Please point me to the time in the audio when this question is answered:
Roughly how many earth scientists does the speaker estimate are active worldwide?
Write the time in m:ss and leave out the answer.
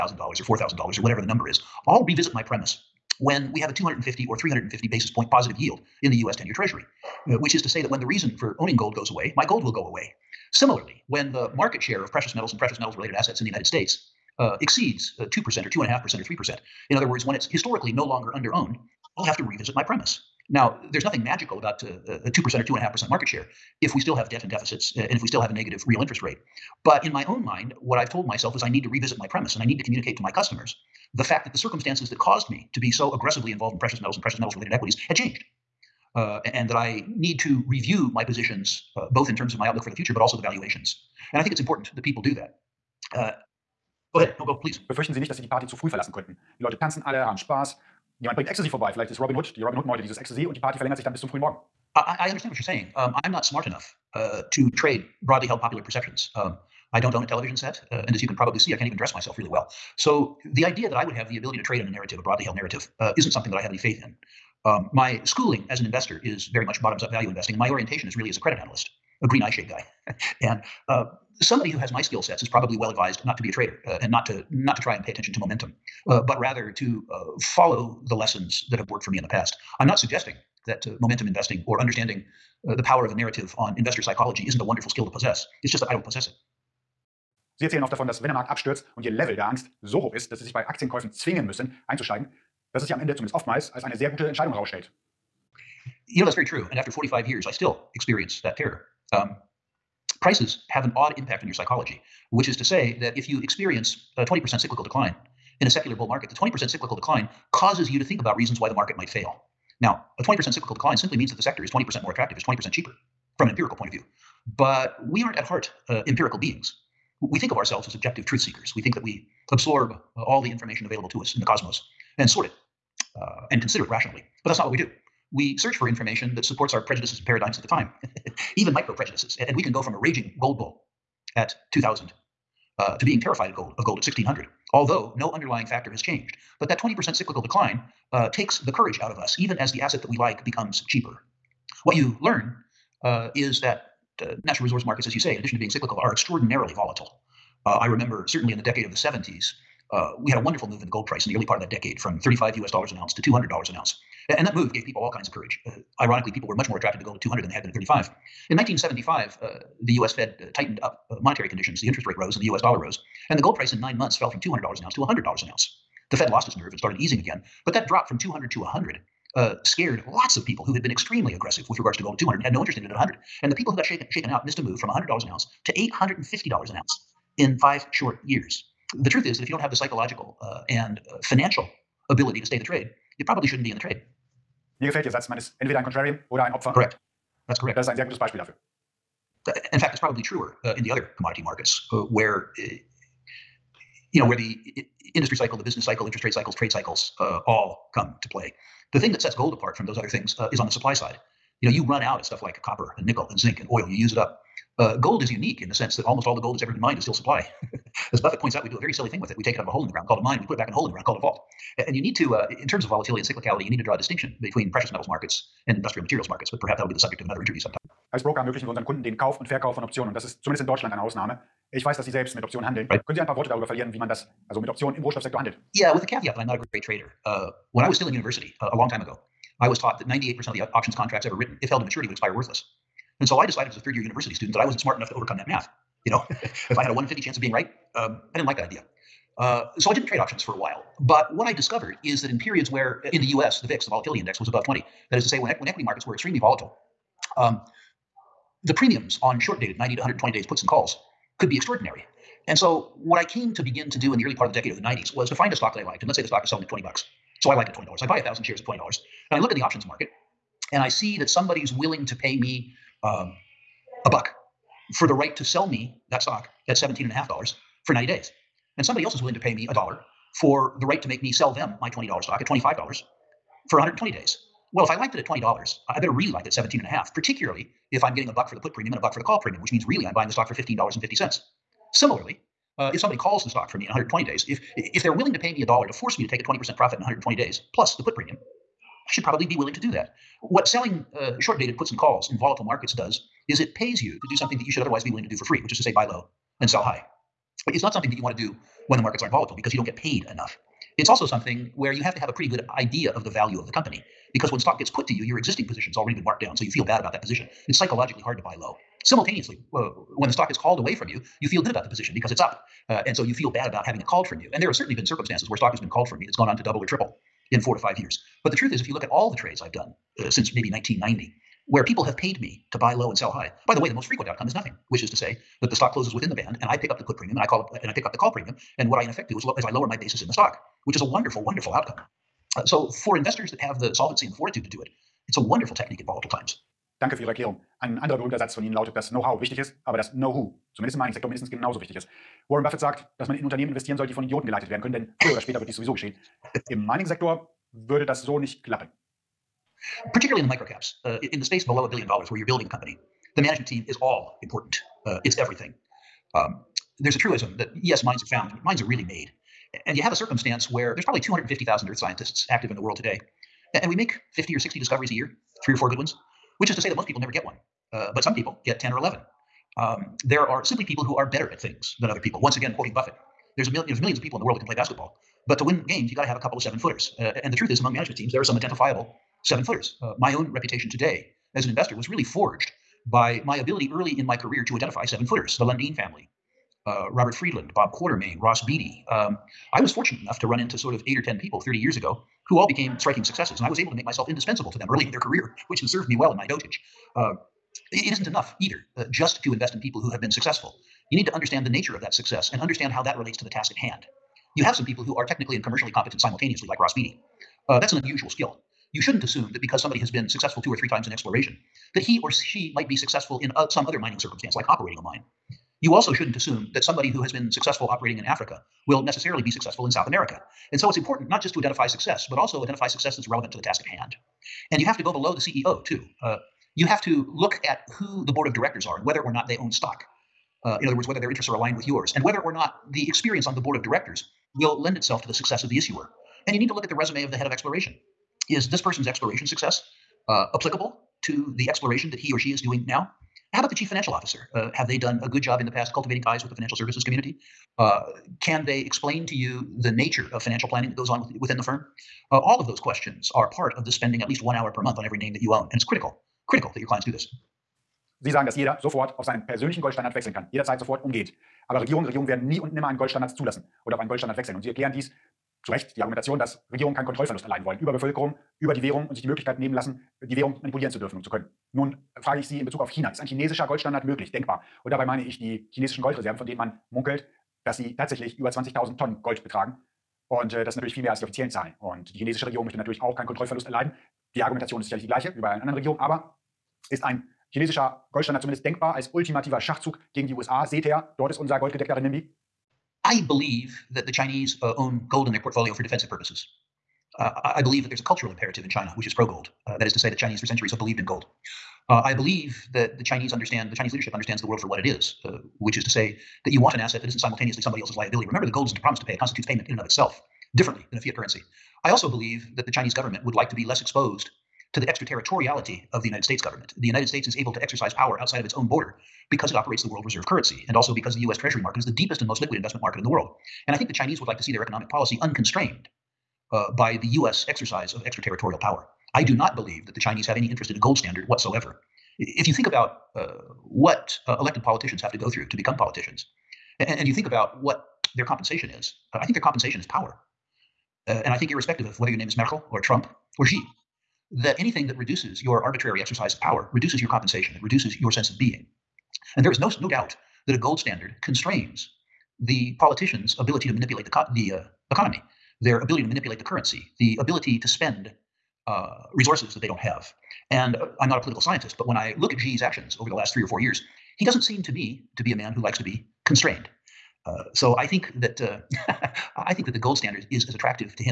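6:01.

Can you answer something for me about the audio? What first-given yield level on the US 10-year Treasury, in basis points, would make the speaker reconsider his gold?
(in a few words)
250.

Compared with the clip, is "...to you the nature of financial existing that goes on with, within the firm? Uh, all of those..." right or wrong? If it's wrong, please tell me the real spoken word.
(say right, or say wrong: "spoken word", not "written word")
wrong: "planning", not "existing".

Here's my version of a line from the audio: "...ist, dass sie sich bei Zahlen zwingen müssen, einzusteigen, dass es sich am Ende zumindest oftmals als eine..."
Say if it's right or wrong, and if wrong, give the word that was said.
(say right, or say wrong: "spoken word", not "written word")
wrong: "Aktienkäufen", not "Zahlen".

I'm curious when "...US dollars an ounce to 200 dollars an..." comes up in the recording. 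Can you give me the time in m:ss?
2:32.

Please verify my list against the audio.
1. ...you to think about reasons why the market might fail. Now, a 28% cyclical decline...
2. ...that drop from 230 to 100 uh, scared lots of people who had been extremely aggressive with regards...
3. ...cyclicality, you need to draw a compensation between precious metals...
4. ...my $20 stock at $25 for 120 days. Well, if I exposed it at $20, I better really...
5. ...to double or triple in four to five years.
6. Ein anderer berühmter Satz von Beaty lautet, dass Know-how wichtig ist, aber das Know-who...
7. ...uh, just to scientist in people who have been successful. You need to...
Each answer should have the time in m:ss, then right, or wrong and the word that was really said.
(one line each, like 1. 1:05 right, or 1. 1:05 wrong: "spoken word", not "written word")
1. 1:47 wrong: "20", not "28"
2. 2:47 wrong: "200", not "230"
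3. 3:33 wrong: "distinction", not "compensation"
4. 4:31 wrong: "liked", not "exposed"
5. 5:16 right
6. 5:37 wrong: "Ihnen", not "Beaty"
7. 6:38 wrong: "invest", not "scientist".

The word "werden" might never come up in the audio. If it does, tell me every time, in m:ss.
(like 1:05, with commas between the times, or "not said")
5:44, 7:42.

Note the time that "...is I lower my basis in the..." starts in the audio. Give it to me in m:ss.
5:29.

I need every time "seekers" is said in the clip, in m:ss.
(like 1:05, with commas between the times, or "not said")
1:58.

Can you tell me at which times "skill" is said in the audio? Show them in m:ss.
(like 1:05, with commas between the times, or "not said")
1:12, 1:24, 6:48.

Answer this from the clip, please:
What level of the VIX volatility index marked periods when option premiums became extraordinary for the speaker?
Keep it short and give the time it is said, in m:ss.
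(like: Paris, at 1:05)
20, at 4:04.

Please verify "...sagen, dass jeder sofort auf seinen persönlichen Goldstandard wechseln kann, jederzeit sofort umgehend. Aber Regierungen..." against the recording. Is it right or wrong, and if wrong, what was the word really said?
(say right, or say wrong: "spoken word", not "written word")
right.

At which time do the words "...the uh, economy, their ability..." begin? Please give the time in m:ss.
9:14.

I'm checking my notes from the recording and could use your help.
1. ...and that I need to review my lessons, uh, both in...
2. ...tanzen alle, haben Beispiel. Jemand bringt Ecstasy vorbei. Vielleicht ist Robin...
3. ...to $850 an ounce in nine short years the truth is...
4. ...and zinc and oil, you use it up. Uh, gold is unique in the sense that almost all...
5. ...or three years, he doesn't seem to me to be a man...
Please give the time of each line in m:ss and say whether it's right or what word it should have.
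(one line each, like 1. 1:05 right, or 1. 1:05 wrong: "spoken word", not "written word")
1. 0:36 wrong: "positions", not "lessons"
2. 0:46 wrong: "Spaß", not "Beispiel"
3. 2:55 wrong: "five", not "nine"
4. 3:23 right
5. 9:23 wrong: "four", not "three".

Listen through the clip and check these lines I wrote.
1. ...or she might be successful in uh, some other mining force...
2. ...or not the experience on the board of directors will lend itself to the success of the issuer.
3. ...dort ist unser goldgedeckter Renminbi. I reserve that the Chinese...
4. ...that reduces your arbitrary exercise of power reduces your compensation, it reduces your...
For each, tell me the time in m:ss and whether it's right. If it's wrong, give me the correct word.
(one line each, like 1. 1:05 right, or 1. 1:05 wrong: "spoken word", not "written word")
1. 6:52 wrong: "circumstance", not "force"
2. 7:12 right
3. 8:11 wrong: "believe", not "reserve"
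4. 9:04 right.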